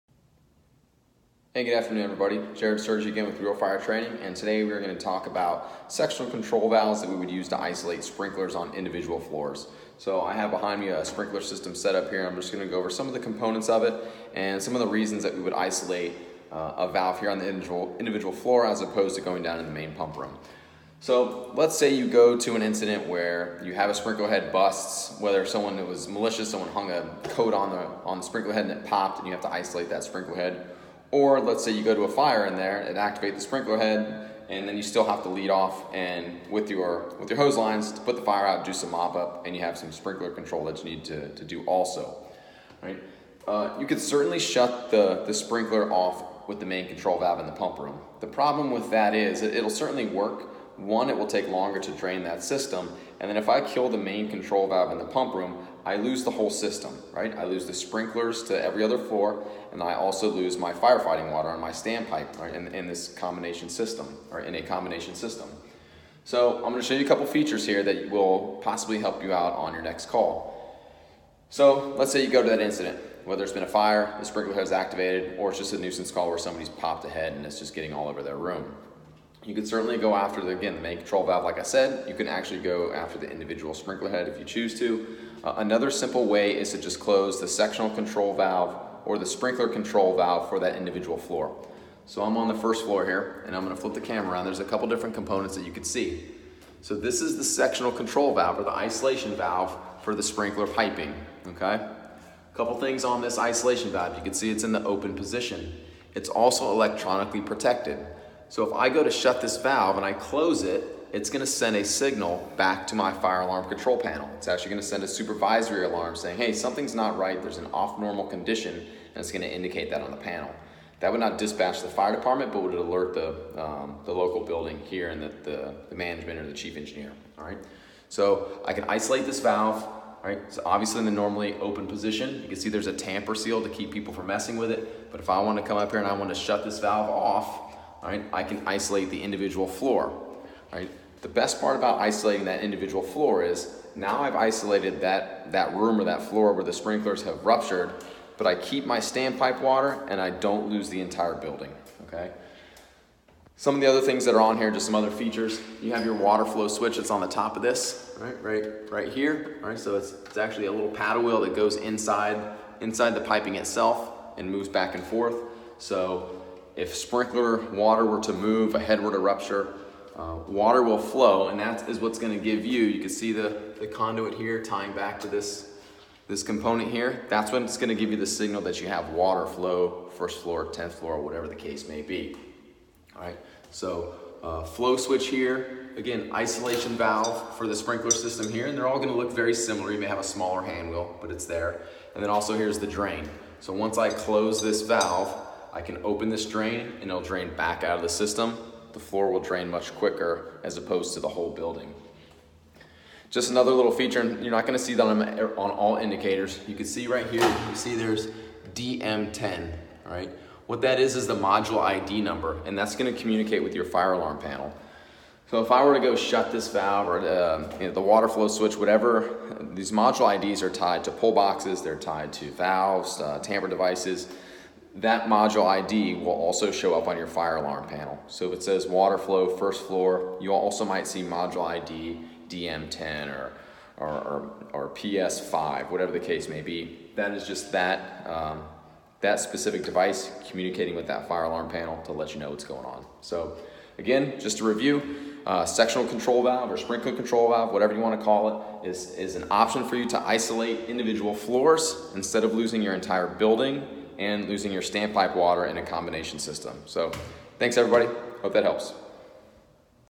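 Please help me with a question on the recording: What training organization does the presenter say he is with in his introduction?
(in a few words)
Real Fire Training.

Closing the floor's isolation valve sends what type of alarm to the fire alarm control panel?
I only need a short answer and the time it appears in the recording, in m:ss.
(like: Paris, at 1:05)
Supervisory alarm, at 1:55.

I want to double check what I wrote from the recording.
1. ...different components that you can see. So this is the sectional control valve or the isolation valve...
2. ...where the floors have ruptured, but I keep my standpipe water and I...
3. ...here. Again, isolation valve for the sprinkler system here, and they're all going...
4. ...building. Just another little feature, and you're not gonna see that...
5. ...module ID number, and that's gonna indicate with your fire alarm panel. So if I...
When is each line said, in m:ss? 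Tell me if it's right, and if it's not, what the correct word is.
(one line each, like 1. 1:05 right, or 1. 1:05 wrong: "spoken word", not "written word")
1. 1:34 right
2. 2:26 wrong: "sprinklers", not "floors"
3. 3:05 right
4. 3:21 right
5. 3:31 wrong: "communicate", not "indicate".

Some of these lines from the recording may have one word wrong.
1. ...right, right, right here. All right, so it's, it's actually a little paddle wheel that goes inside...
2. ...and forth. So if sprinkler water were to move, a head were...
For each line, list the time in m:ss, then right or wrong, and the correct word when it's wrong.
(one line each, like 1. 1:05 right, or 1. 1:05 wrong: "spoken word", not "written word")
1. 2:38 right
2. 2:44 right.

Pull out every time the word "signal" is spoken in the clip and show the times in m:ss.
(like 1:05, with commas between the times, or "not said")
1:51, 2:58.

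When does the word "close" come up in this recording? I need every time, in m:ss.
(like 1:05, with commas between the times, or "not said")
1:26, 1:50, 3:14.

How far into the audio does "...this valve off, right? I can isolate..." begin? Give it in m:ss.
2:16.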